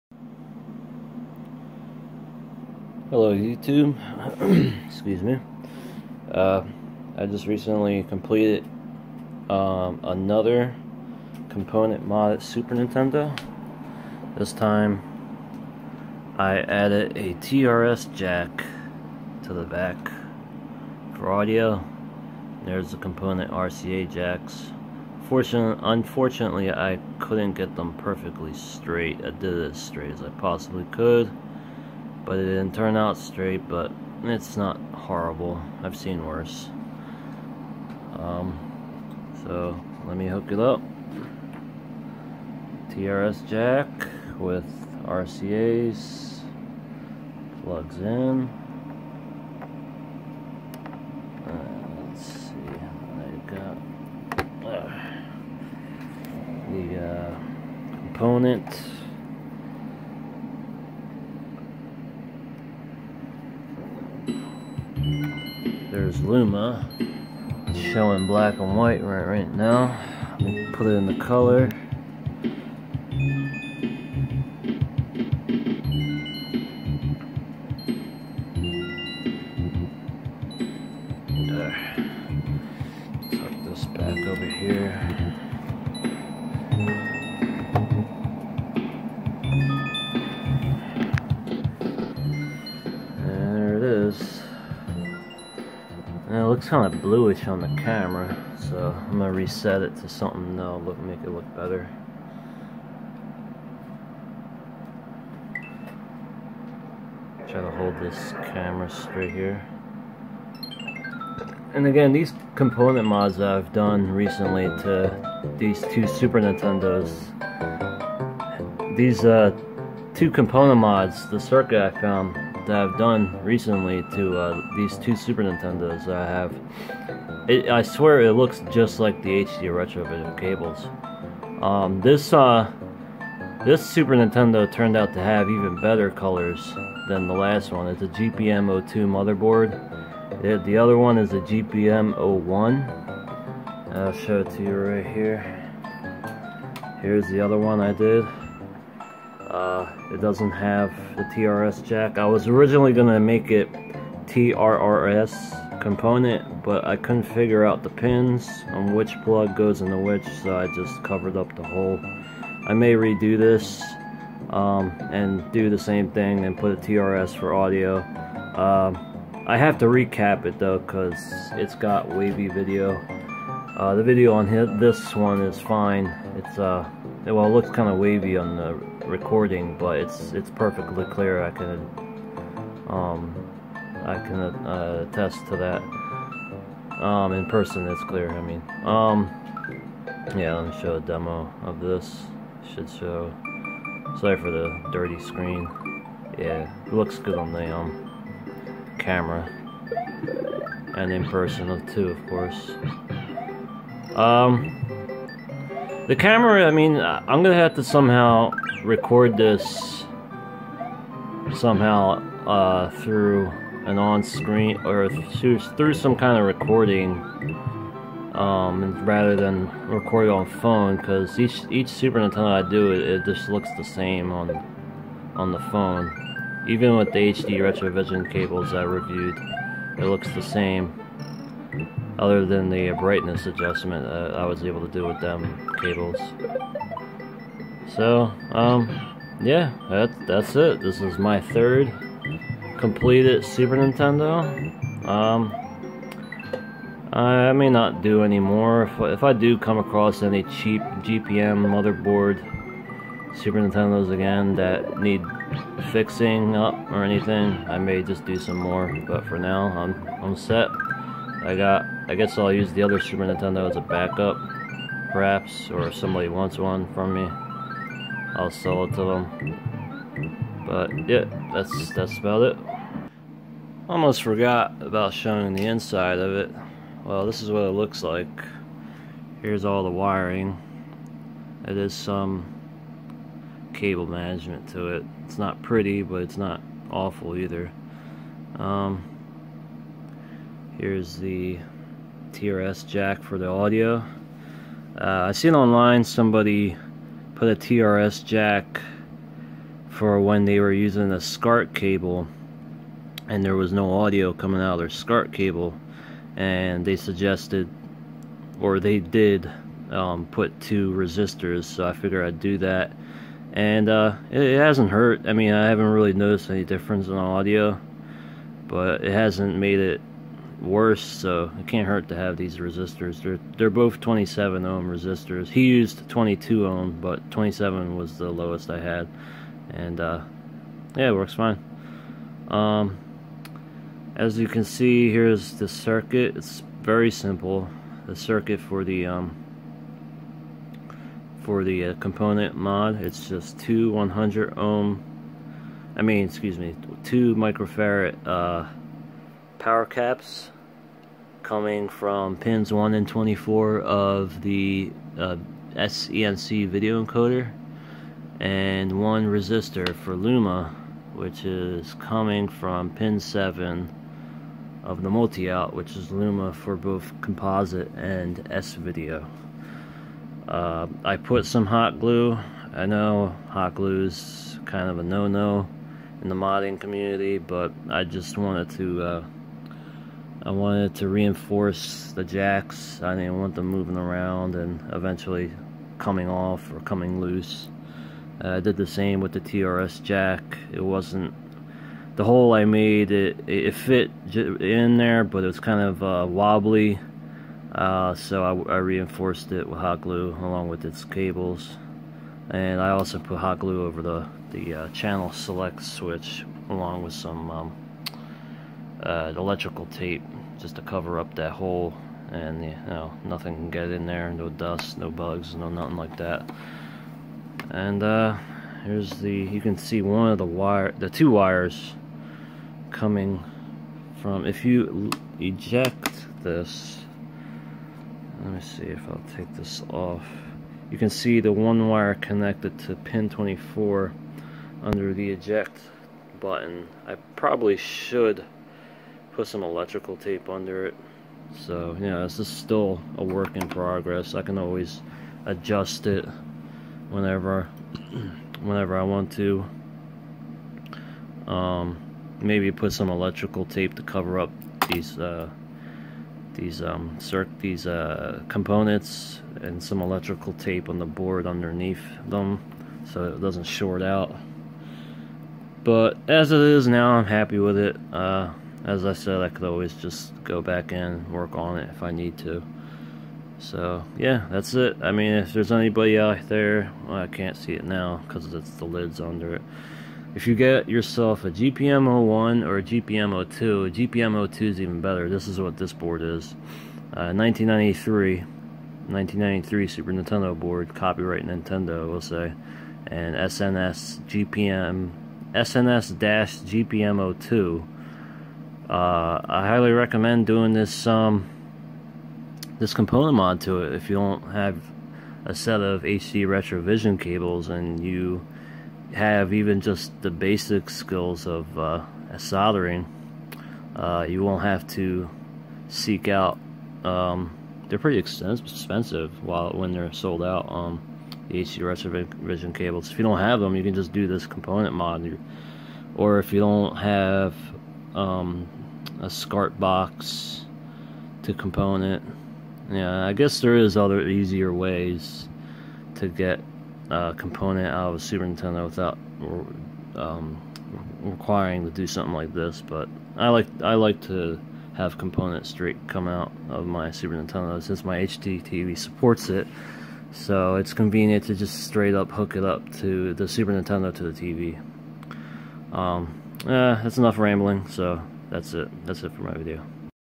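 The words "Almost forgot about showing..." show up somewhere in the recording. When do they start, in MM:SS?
04:33.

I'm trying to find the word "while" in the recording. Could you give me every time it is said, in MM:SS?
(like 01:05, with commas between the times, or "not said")
08:39.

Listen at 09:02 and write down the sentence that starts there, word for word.
But I like I like to have component straight come out of my Super Nintendo since my HDTV supports it.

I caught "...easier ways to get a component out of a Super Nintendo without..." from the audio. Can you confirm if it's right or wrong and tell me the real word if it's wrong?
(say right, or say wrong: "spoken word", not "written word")
right.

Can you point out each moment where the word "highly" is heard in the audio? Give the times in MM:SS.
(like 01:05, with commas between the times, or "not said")
08:19.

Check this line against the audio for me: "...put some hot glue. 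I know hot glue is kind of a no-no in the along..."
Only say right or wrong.
wrong.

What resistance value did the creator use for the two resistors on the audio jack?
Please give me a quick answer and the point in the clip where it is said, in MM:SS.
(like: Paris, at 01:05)
27 ohm, at 05:23.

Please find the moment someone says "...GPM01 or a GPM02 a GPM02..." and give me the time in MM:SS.
08:01.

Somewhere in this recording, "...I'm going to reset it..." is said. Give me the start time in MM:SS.
01:38.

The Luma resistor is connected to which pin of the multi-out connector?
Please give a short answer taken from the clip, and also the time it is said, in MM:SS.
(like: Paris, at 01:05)
7, at 06:02.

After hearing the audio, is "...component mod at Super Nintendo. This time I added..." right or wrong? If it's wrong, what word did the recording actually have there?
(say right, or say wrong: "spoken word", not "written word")
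right.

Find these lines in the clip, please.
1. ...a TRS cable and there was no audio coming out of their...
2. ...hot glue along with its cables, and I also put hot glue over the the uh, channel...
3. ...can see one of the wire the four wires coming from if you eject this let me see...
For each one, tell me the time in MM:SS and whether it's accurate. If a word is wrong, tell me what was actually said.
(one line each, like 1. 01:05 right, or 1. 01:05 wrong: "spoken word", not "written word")
1. 05:01 wrong: "SCART", not "TRS"
2. 06:39 right
3. 06:59 wrong: "two", not "four".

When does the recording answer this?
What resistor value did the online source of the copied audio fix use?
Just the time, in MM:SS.
05:26.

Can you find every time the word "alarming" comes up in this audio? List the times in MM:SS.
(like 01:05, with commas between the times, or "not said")
not said.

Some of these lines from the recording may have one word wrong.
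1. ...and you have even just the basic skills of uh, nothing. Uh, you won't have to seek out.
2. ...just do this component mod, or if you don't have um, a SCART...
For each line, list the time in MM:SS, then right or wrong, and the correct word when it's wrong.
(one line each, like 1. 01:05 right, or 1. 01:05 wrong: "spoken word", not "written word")
1. 08:27 wrong: "soldering", not "nothing"
2. 08:43 right.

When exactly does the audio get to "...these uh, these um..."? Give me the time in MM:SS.
07:34.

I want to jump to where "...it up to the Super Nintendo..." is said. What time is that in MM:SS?
09:12.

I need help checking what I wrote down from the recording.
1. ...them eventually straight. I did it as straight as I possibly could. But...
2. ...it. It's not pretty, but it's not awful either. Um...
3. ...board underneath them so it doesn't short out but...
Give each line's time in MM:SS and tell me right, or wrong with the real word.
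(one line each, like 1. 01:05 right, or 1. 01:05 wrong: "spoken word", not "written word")
1. 00:27 wrong: "perfectly", not "eventually"
2. 04:44 right
3. 07:41 right.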